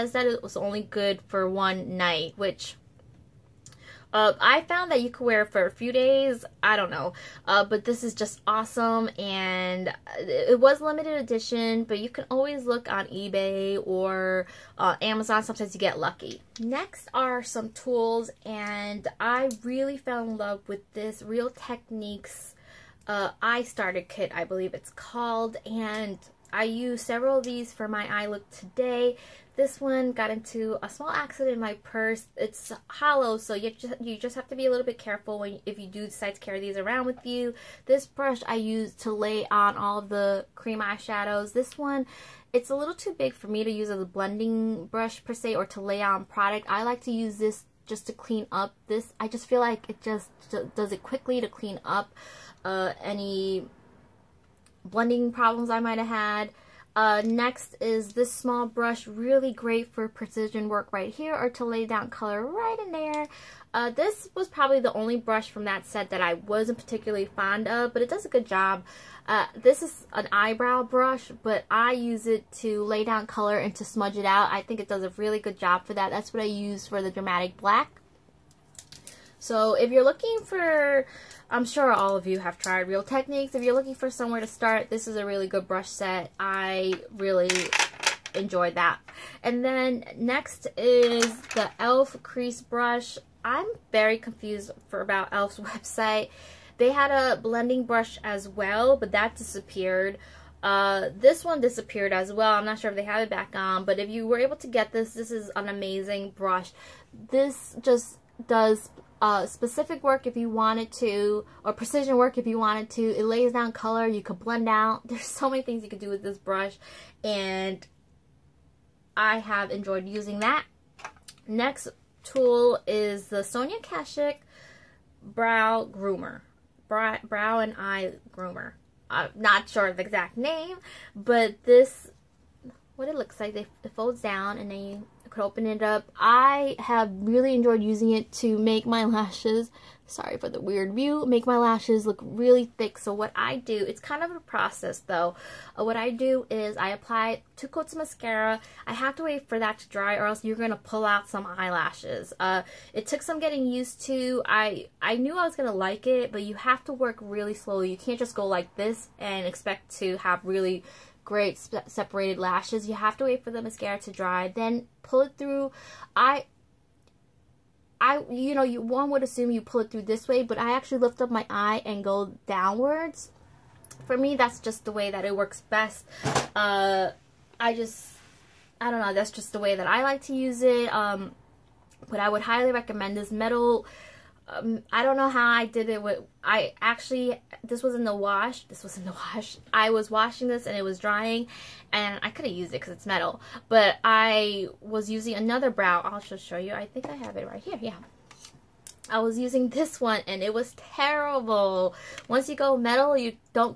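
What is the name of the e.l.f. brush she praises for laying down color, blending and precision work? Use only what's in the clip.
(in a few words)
Crease Brush.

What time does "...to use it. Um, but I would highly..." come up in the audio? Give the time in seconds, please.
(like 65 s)
180 s.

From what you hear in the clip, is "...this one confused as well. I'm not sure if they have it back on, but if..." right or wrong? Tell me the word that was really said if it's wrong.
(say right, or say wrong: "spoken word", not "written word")
wrong: "disappeared", not "confused".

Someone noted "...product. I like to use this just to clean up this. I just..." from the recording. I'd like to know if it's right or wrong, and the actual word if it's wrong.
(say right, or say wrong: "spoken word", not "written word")
right.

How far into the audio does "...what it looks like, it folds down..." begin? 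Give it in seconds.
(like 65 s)
132 s.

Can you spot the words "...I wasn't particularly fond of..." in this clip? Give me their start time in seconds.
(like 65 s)
66 s.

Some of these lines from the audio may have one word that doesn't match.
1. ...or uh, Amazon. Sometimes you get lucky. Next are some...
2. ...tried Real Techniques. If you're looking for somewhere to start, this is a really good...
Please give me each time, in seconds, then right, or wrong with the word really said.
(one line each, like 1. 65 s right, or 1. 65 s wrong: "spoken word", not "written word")
1. 13 s right
2. 82 s right.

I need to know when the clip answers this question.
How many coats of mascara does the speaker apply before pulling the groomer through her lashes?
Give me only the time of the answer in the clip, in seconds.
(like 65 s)
147 s.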